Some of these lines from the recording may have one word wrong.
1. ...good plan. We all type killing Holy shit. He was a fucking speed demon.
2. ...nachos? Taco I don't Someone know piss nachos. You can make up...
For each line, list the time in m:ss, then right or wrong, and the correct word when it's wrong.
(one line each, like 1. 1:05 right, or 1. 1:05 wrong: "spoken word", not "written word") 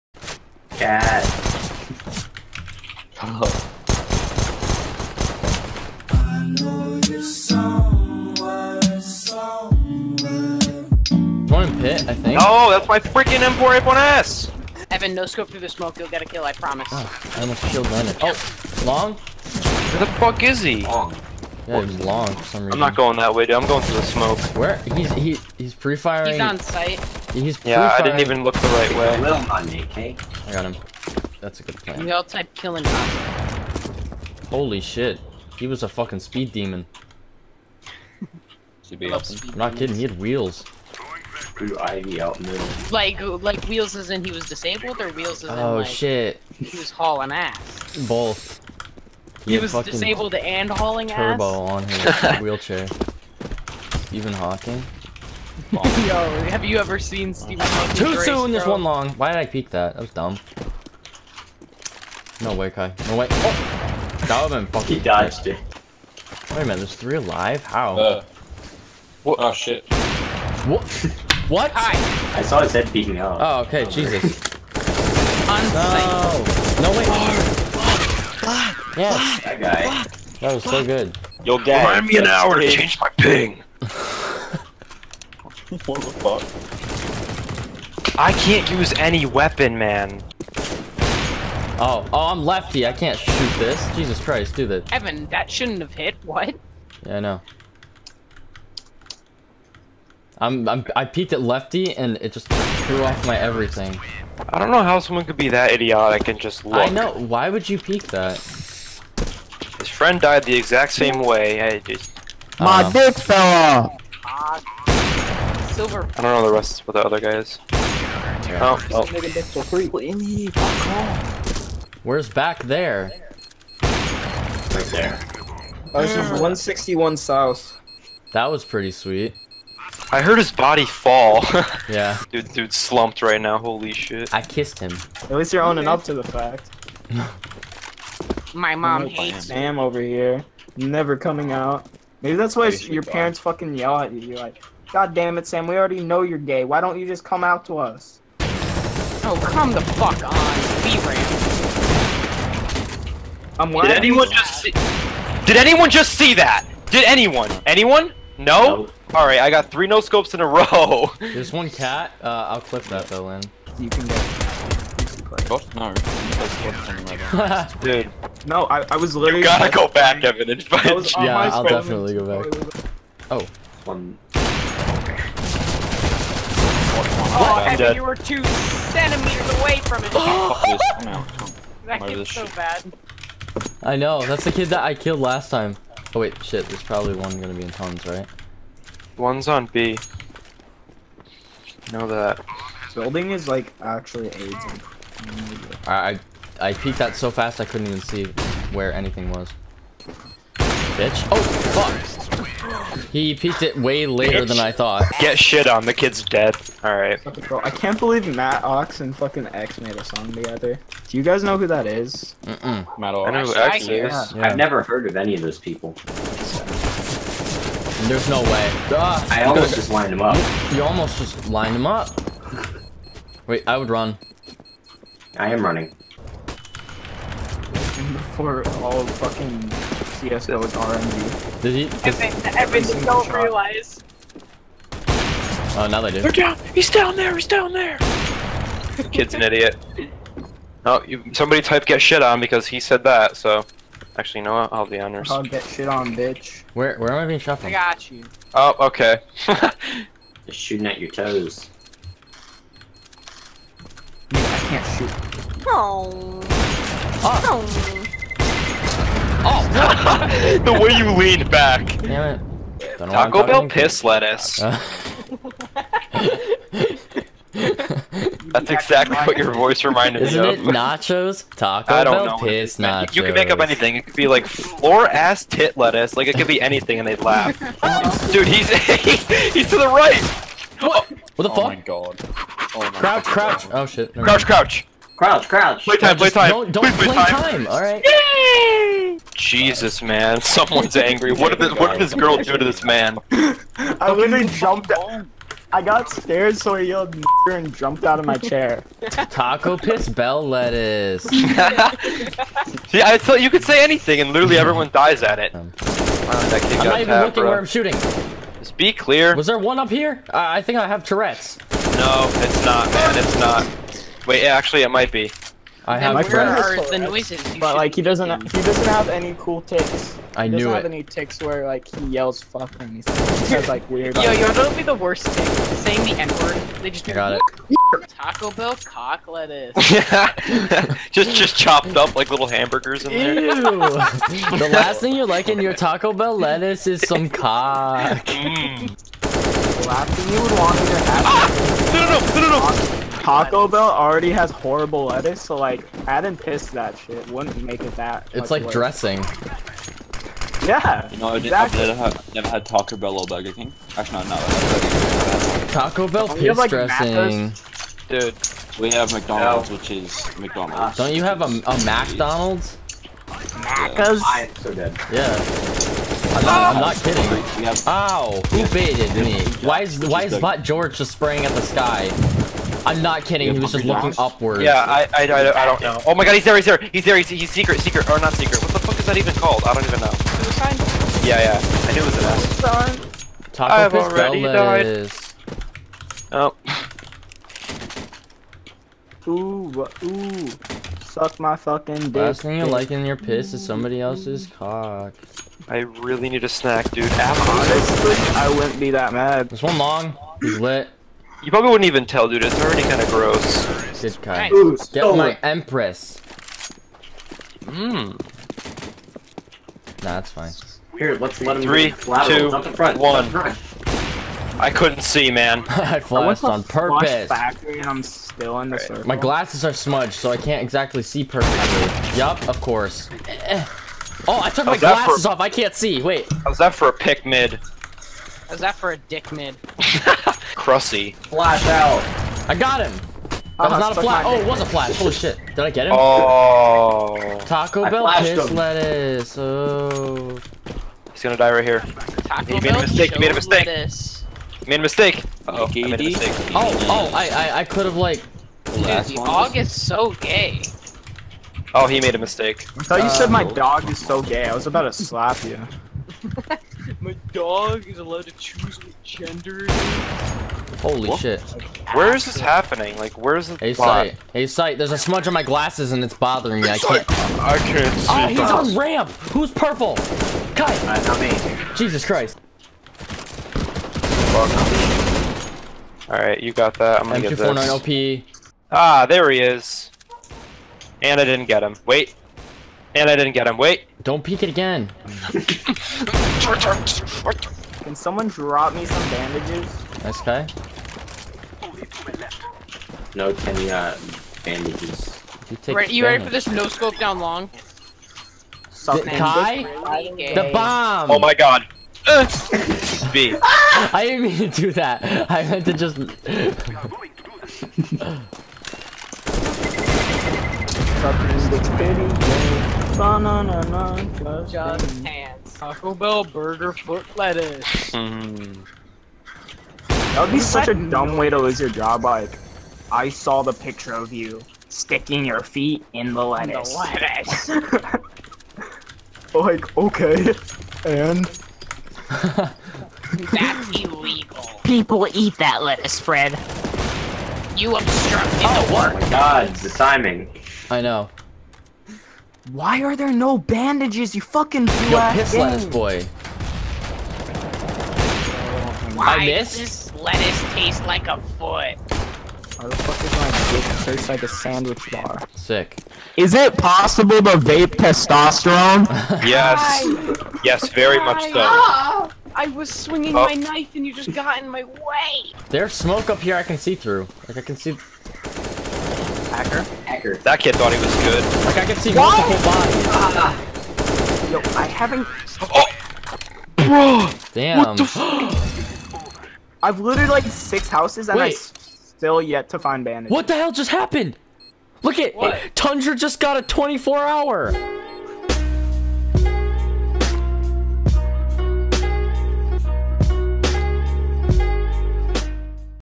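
1. 0:31 right
2. 4:30 wrong: "Bell", not "Someone".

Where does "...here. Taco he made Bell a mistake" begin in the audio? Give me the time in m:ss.
7:21.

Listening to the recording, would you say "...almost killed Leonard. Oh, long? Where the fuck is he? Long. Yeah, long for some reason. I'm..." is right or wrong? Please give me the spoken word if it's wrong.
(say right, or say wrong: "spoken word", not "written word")
right.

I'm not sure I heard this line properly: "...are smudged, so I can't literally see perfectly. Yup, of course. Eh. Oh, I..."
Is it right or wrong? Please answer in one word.
wrong.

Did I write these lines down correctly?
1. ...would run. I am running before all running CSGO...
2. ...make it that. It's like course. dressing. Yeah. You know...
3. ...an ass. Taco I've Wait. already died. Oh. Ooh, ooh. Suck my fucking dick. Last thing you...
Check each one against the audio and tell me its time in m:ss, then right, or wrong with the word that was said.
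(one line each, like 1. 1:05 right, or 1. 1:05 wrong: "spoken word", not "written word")
1. 3:43 wrong: "fucking", not "running"
2. 5:47 wrong: "worse", not "course"
3. 6:22 wrong: "Pistoles", not "Wait".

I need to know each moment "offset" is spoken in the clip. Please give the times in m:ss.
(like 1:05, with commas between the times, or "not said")
not said.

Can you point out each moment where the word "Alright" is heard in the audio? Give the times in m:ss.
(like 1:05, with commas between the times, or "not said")
2:39, 3:26, 7:56.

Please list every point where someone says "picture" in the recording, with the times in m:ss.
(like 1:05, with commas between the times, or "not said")
8:43.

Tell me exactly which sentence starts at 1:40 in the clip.
I'm, I'm, I peeked at lefty and it just threw off my everything.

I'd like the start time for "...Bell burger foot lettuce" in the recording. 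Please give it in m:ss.
8:35.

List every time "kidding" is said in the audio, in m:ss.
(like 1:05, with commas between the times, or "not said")
0:39, 6:07, 6:13.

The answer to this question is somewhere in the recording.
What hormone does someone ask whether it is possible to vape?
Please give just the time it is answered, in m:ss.
9:17.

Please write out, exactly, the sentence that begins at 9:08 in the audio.
Why I missed lettuce taste like a foot?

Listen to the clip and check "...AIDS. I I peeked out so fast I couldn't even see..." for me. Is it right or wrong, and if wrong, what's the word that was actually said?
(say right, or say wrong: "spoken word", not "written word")
right.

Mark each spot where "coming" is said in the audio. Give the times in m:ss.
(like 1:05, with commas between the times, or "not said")
2:21.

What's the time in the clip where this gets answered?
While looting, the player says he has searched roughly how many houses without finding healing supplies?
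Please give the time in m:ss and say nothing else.
9:40.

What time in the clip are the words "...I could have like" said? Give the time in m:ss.
7:27.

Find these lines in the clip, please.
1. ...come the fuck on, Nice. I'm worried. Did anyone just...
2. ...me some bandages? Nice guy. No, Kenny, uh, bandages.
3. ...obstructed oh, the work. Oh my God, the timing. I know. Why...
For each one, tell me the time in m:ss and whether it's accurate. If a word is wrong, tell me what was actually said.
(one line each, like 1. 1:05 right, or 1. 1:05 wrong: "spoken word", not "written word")
1. 2:29 wrong: "VRAM", not "Nice"
2. 8:08 right
3. 8:57 right.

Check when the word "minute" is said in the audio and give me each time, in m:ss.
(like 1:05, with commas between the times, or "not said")
1:06.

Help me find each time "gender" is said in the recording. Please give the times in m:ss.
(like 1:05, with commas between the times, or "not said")
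7:39.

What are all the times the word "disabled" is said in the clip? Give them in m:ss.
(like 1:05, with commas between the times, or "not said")
0:44, 0:49.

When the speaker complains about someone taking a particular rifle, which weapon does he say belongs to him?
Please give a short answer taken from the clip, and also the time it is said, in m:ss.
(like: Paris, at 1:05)
M4A1S, at 0:13.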